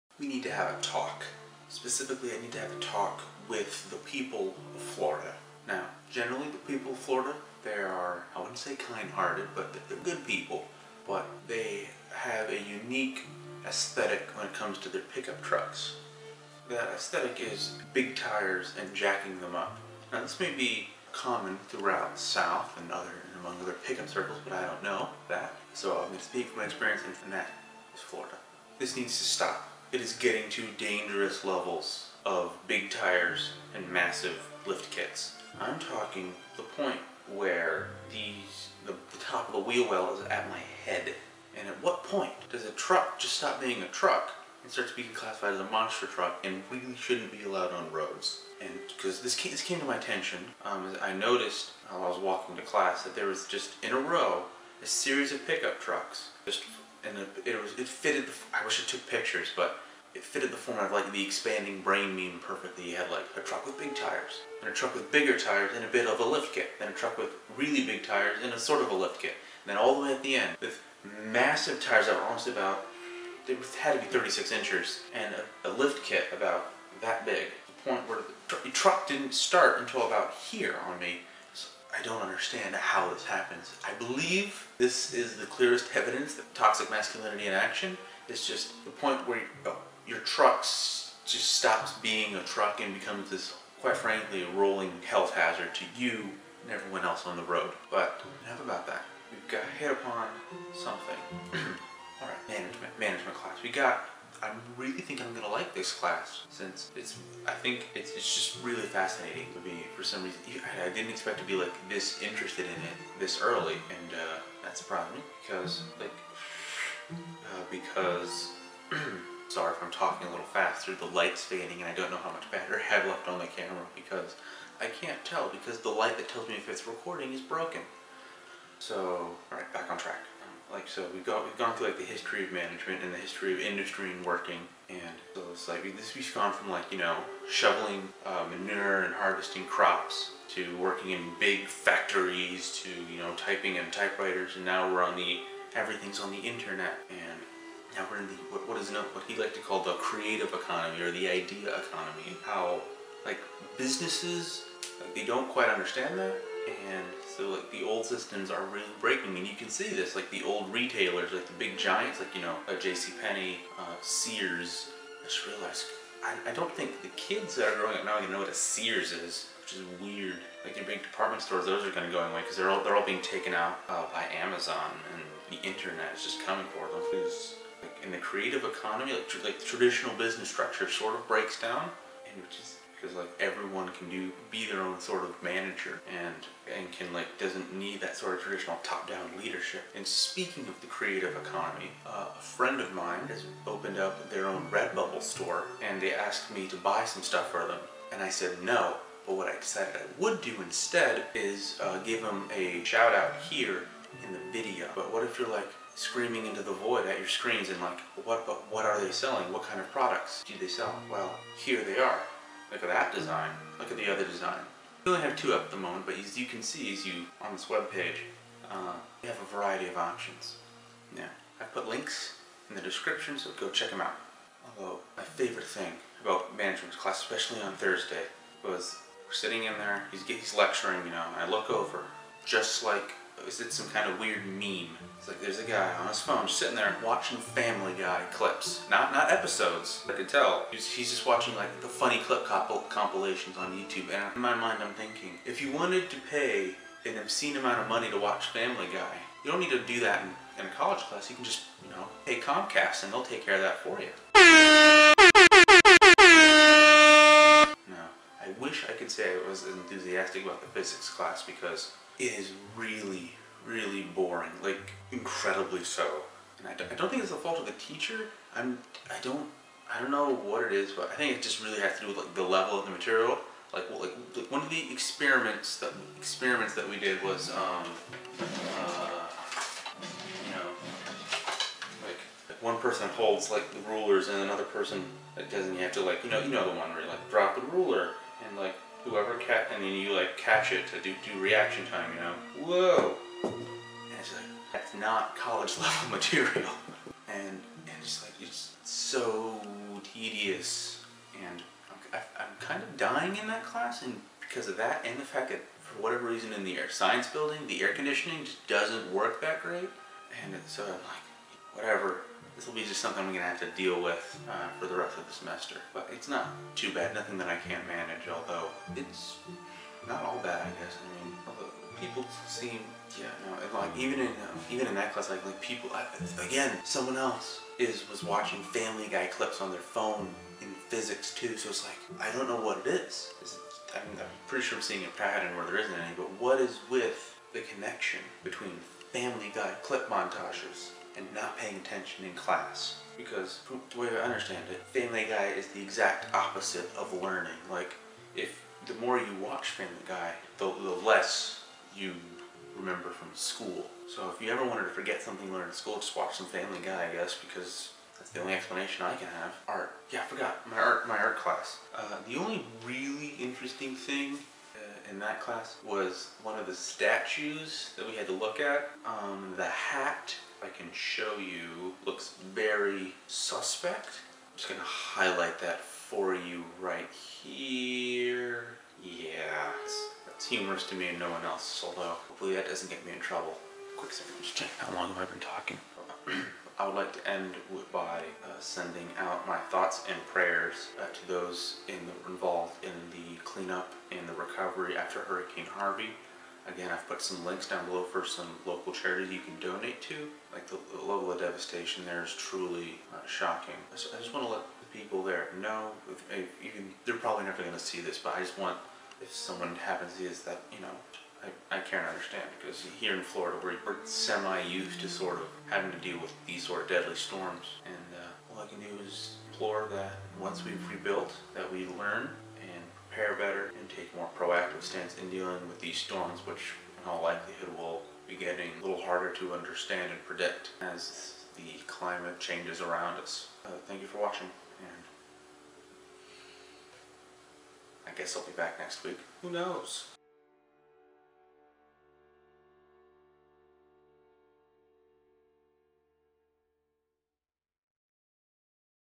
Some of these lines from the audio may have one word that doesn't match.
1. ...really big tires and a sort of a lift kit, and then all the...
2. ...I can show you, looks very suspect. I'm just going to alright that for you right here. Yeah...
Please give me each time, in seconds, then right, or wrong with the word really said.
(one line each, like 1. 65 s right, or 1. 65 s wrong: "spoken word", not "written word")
1. 67 s right
2. 370 s wrong: "highlight", not "alright".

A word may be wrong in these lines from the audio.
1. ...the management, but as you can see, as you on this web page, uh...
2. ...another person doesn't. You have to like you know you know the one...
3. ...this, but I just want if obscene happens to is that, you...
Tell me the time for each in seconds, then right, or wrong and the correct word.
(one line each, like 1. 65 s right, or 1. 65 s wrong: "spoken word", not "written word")
1. 215 s wrong: "moment", not "management"
2. 284 s right
3. 408 s wrong: "someone", not "obscene".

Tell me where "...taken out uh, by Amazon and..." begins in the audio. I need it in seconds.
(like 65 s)
173 s.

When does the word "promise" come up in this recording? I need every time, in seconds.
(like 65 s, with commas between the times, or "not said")
not said.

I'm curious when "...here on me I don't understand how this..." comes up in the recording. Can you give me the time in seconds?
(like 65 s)
80 s.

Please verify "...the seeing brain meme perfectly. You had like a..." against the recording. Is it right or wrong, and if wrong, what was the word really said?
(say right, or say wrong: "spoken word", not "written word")
wrong: "expanding", not "seeing".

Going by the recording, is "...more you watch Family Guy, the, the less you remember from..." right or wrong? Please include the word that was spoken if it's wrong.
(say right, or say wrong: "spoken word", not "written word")
right.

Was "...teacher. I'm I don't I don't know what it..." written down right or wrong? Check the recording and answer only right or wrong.
right.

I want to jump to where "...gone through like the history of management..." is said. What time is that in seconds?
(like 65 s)
131 s.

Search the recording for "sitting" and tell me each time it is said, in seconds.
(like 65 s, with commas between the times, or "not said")
229 s, 236 s.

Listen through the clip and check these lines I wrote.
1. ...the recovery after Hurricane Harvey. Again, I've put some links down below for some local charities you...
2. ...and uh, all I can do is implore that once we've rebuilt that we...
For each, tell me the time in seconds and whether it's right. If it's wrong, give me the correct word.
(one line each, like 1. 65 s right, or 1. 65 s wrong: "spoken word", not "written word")
1. 394 s right
2. 417 s right.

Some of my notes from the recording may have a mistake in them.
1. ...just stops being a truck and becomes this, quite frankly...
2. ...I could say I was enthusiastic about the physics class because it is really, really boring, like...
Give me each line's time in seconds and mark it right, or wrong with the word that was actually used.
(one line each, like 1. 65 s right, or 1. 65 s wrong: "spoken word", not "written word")
1. 90 s right
2. 258 s right.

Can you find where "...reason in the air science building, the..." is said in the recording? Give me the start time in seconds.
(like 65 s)
306 s.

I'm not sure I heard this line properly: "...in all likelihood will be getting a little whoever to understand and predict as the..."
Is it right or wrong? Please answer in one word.
wrong.